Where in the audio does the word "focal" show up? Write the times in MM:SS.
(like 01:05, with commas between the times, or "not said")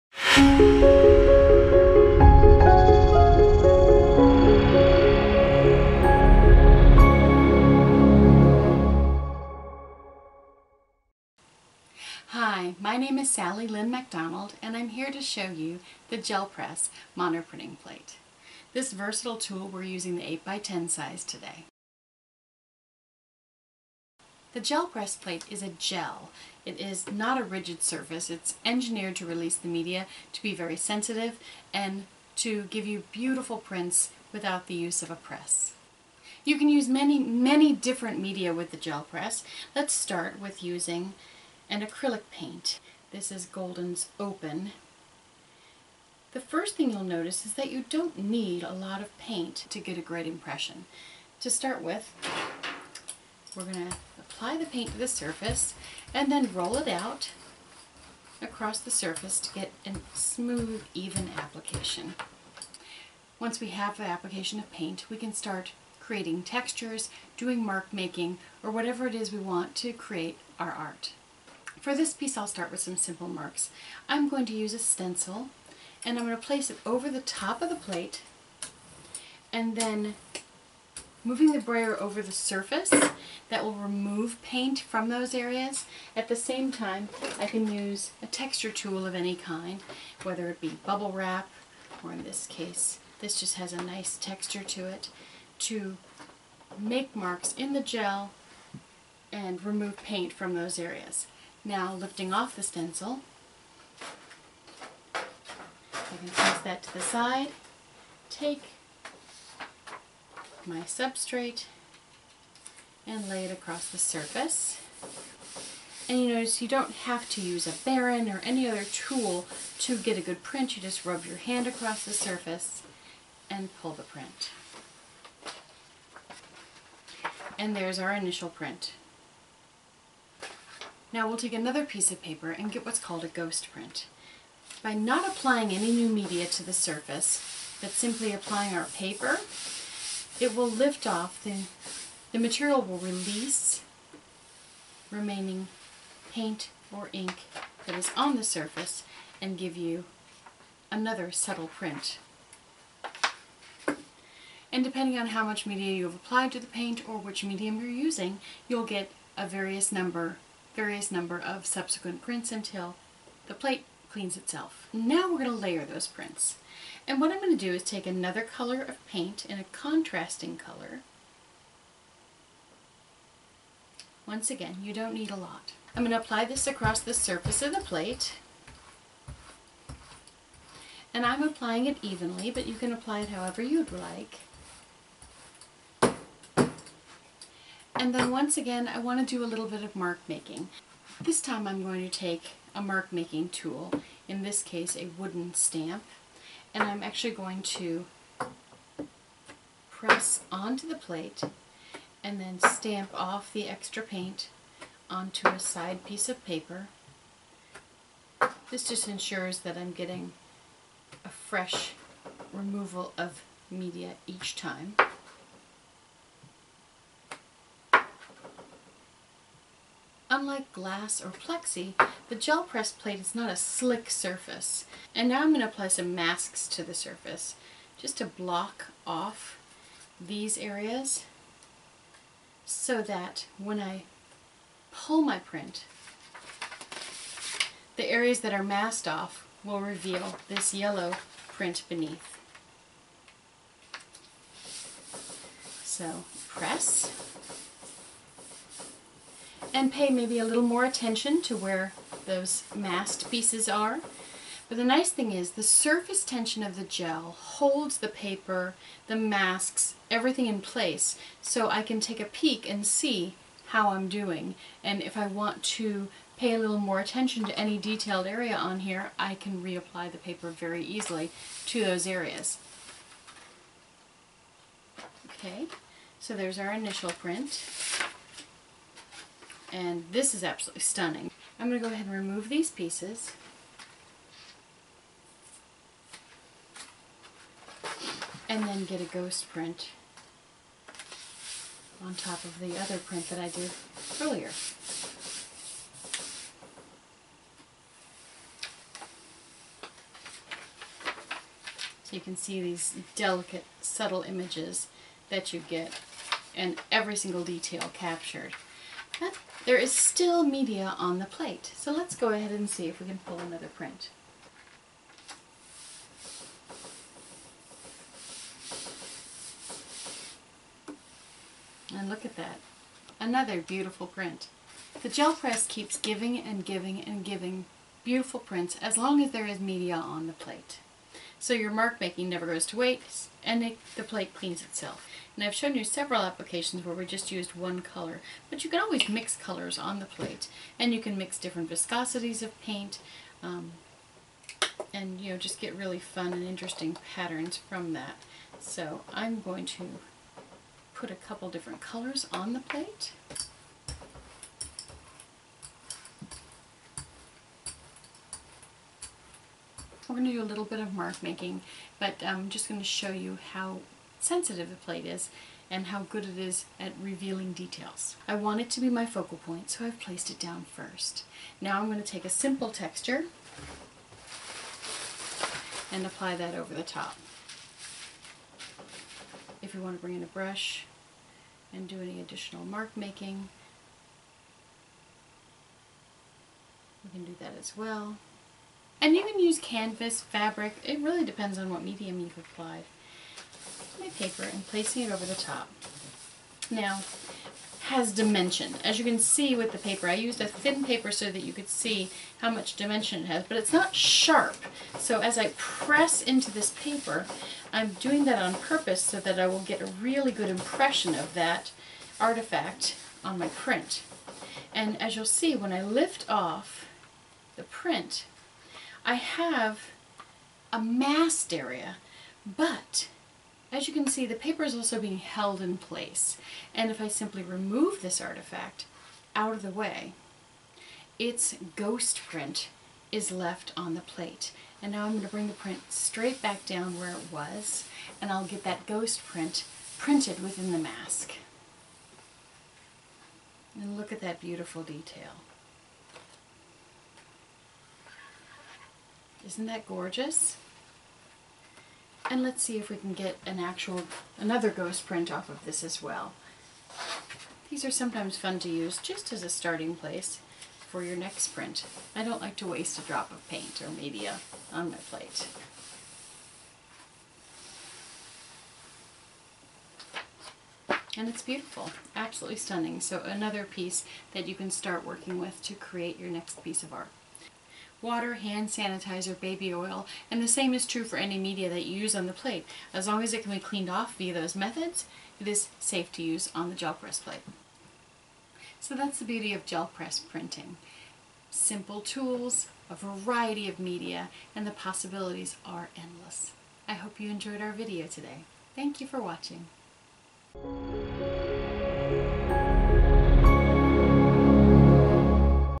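06:09.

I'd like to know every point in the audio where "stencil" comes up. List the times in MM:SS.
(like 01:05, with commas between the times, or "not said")
01:14, 01:42.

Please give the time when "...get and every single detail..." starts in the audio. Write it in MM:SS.
05:05.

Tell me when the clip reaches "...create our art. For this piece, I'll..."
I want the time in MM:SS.
01:09.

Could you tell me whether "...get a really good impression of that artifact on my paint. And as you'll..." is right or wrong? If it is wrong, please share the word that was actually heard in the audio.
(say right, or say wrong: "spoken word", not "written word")
wrong: "print", not "paint".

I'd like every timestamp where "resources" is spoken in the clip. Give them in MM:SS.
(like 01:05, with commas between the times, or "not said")
not said.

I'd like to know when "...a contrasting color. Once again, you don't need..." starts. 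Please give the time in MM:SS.
02:49.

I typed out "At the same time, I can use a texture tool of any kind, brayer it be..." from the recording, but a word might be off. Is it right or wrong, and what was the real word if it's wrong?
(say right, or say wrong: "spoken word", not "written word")
wrong: "whether", not "brayer".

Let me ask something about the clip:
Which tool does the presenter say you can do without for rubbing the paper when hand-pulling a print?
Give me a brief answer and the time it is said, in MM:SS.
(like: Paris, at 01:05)
A baren, at 01:57.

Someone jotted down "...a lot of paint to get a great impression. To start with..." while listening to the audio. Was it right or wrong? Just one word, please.
right.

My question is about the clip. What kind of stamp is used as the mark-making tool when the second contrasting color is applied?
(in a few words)
Wooden stamp.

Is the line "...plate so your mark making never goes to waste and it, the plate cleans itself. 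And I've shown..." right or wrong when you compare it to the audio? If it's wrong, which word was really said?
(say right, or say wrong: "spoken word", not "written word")
right.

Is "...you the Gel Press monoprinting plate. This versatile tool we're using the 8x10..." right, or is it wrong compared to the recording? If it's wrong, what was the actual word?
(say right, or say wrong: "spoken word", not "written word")
right.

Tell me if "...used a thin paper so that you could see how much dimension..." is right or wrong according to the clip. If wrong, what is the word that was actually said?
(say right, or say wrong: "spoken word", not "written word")
right.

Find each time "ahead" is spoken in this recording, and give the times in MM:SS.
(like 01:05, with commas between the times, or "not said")
04:41, 05:12.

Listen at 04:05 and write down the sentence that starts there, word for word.
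So press and pay maybe a little more attention to where those masked pieces are.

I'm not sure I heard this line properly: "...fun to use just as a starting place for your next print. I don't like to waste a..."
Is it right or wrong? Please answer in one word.
right.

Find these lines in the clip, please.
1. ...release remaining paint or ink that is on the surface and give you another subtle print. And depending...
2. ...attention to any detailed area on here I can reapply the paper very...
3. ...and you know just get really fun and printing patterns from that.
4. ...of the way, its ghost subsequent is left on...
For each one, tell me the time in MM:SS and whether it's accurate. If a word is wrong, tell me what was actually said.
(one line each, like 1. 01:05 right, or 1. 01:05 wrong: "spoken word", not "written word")
1. 02:22 right
2. 04:26 right
3. 05:44 wrong: "interesting", not "printing"
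4. 07:09 wrong: "print", not "subsequent".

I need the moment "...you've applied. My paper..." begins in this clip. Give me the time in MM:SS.
06:32.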